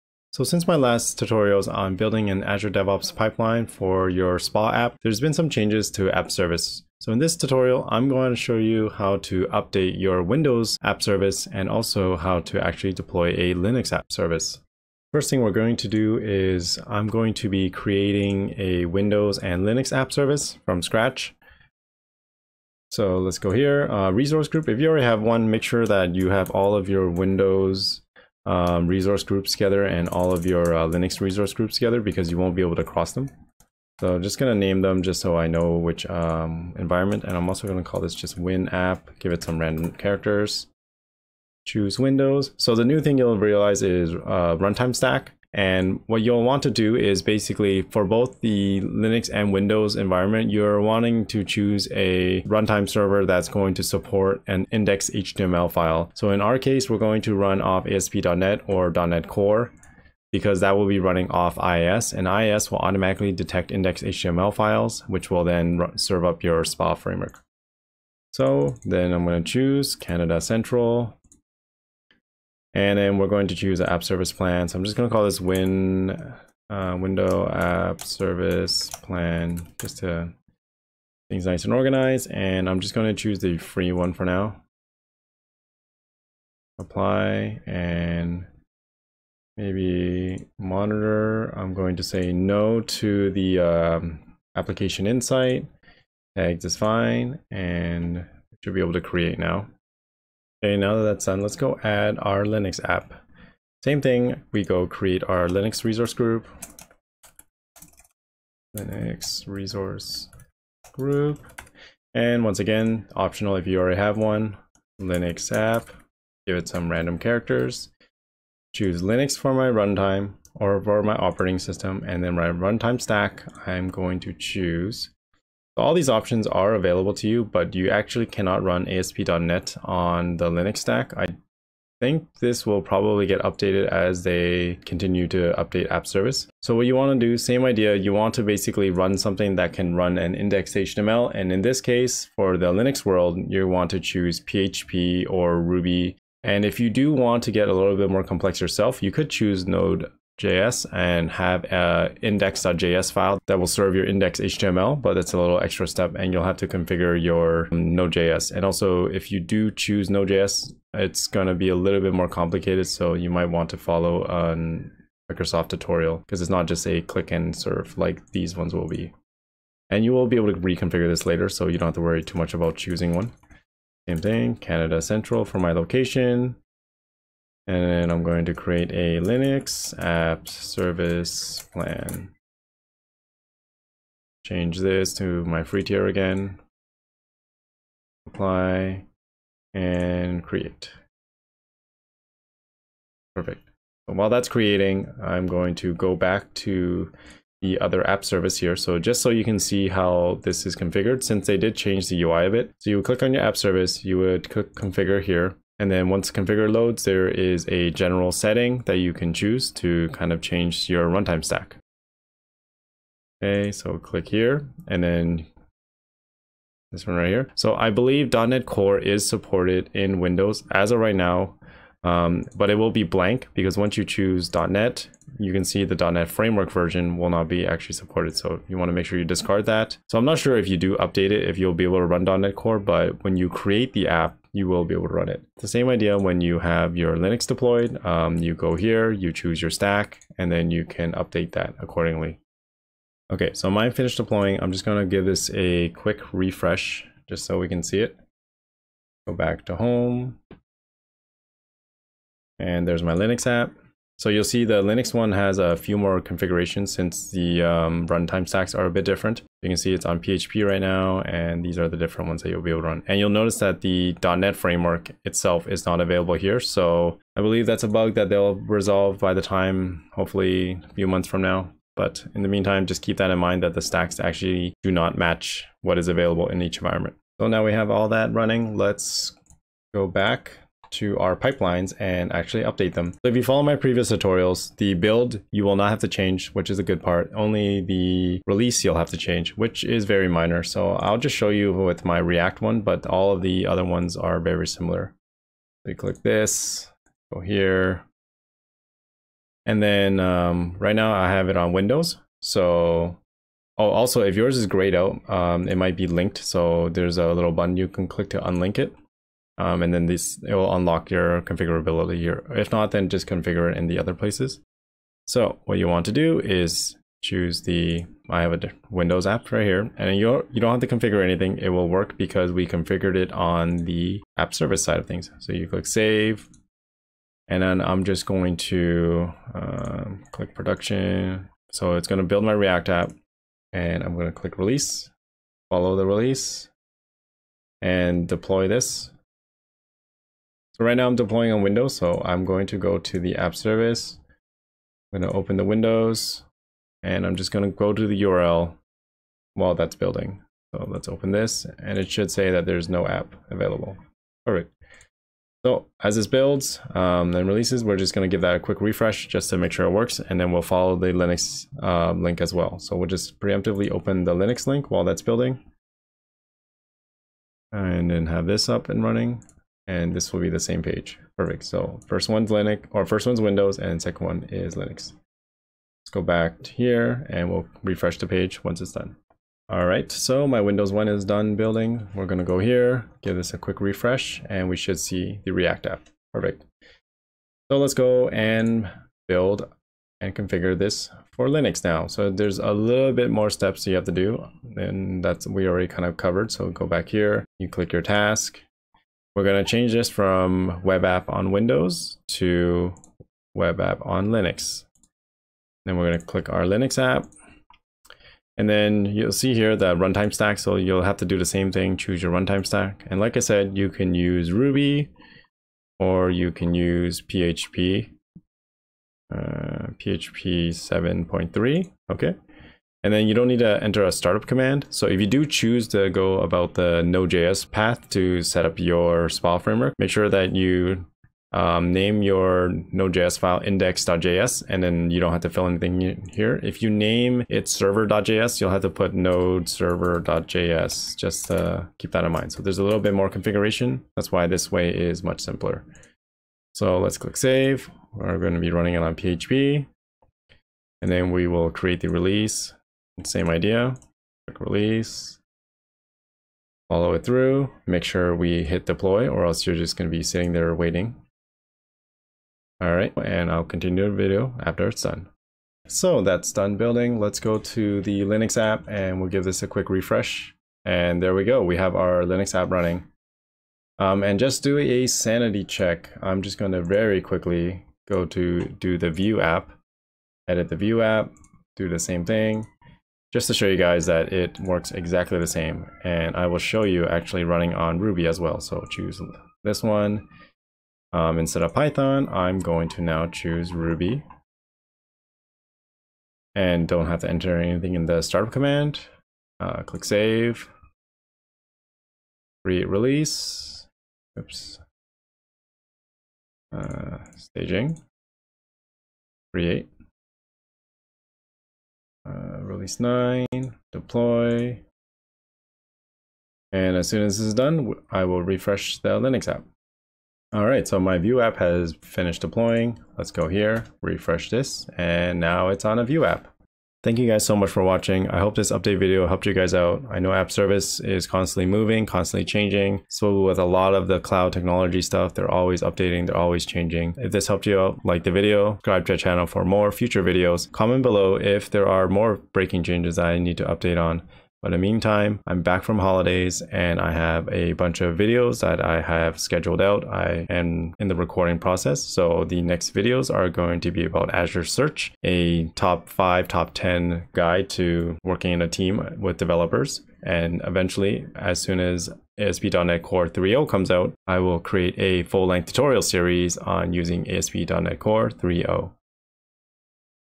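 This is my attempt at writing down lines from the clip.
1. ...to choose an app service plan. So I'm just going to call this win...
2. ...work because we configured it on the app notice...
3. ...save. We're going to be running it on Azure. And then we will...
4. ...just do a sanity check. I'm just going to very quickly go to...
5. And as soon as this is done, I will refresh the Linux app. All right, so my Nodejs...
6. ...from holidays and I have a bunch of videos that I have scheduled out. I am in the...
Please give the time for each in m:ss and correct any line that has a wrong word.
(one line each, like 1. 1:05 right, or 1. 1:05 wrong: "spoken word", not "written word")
1. 1:13 right
2. 5:21 wrong: "service", not "notice"
3. 7:27 wrong: "PHP", not "Azure"
4. 7:54 right
5. 8:36 wrong: "Vue", not "Nodejs"
6. 9:05 right.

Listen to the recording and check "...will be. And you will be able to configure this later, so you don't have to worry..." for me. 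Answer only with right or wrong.
wrong.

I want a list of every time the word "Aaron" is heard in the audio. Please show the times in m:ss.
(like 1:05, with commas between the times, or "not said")
not said.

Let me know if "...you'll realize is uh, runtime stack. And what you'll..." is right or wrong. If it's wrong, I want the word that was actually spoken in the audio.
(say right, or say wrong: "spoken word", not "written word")
right.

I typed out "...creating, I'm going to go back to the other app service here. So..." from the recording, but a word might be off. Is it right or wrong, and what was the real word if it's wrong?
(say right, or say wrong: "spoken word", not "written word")
right.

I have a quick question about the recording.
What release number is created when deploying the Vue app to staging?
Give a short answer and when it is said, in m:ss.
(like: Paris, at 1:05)
9, at 8:32.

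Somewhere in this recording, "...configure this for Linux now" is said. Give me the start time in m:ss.
6:30.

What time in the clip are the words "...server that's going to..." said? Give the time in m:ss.
0:52.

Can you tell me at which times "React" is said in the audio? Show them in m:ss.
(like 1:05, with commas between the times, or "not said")
4:52, 5:32, 6:25.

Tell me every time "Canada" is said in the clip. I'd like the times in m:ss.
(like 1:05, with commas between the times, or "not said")
1:09, 2:54.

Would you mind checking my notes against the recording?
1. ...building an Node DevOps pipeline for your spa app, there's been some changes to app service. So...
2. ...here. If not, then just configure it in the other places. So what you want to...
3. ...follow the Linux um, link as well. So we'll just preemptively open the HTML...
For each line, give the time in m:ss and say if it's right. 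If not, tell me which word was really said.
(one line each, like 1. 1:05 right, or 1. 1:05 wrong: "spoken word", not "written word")
1. 0:01 wrong: "Azure", not "Node"
2. 5:12 right
3. 6:00 wrong: "Linux", not "HTML".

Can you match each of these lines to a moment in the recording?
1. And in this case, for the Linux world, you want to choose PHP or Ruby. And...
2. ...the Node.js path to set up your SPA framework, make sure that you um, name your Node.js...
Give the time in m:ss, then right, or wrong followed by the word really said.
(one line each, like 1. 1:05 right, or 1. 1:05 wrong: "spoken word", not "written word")
1. 2:21 right
2. 7:06 right.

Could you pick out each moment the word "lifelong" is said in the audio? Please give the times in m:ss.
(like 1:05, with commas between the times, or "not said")
not said.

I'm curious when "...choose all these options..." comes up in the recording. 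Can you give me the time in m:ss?
2:04.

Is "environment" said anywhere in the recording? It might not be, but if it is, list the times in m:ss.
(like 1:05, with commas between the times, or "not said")
0:36, 0:49, 4:36.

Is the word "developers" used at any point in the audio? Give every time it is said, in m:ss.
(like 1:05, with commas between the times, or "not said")
9:19.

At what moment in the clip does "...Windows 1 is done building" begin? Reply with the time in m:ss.
6:20.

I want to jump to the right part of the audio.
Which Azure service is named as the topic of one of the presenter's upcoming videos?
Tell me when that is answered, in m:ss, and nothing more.
9:14.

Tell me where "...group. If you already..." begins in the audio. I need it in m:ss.
0:24.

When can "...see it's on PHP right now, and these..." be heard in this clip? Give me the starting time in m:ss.
4:19.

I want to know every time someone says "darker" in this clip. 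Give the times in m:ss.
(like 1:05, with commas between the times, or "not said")
not said.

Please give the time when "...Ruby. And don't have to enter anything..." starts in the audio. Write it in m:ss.
8:13.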